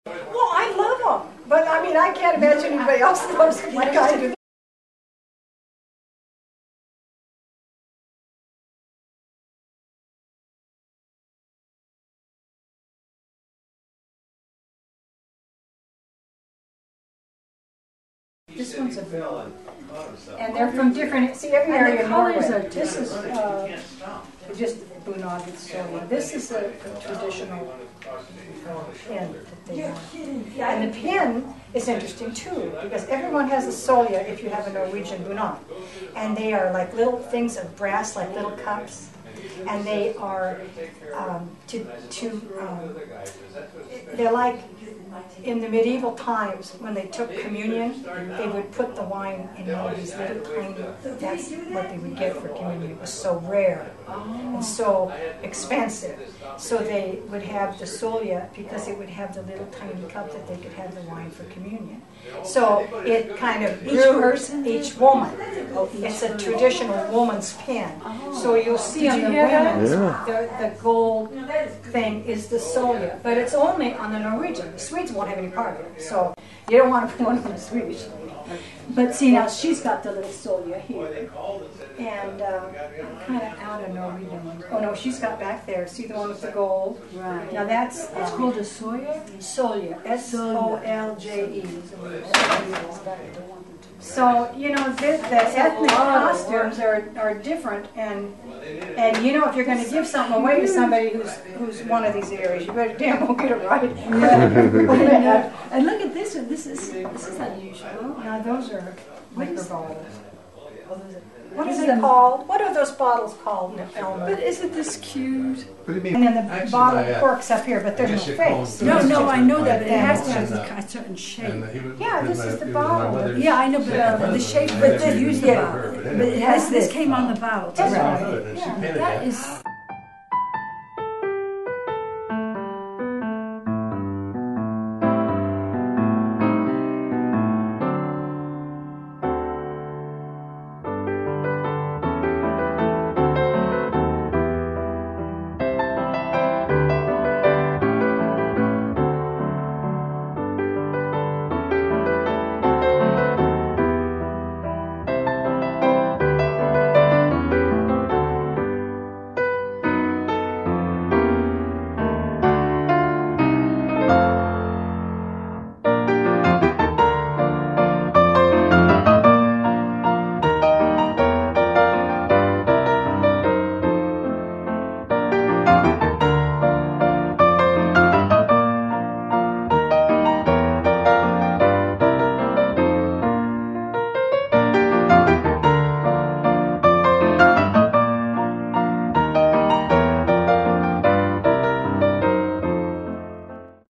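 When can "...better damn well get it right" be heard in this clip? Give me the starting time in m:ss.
1:42.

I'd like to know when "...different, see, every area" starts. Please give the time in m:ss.
0:20.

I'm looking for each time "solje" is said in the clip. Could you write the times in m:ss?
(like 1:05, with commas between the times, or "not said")
0:25, 0:33, 0:57.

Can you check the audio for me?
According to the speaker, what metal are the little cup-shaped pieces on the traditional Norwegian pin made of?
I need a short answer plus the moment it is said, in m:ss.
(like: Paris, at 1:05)
Brass, at 0:37.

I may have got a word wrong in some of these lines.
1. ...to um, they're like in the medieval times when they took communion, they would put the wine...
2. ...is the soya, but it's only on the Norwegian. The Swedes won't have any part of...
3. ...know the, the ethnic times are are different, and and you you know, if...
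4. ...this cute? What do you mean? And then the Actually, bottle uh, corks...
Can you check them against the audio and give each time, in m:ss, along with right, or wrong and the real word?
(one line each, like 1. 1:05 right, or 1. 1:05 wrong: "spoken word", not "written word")
1. 0:42 right
2. 1:12 right
3. 1:34 wrong: "costumes", not "times"
4. 1:54 right.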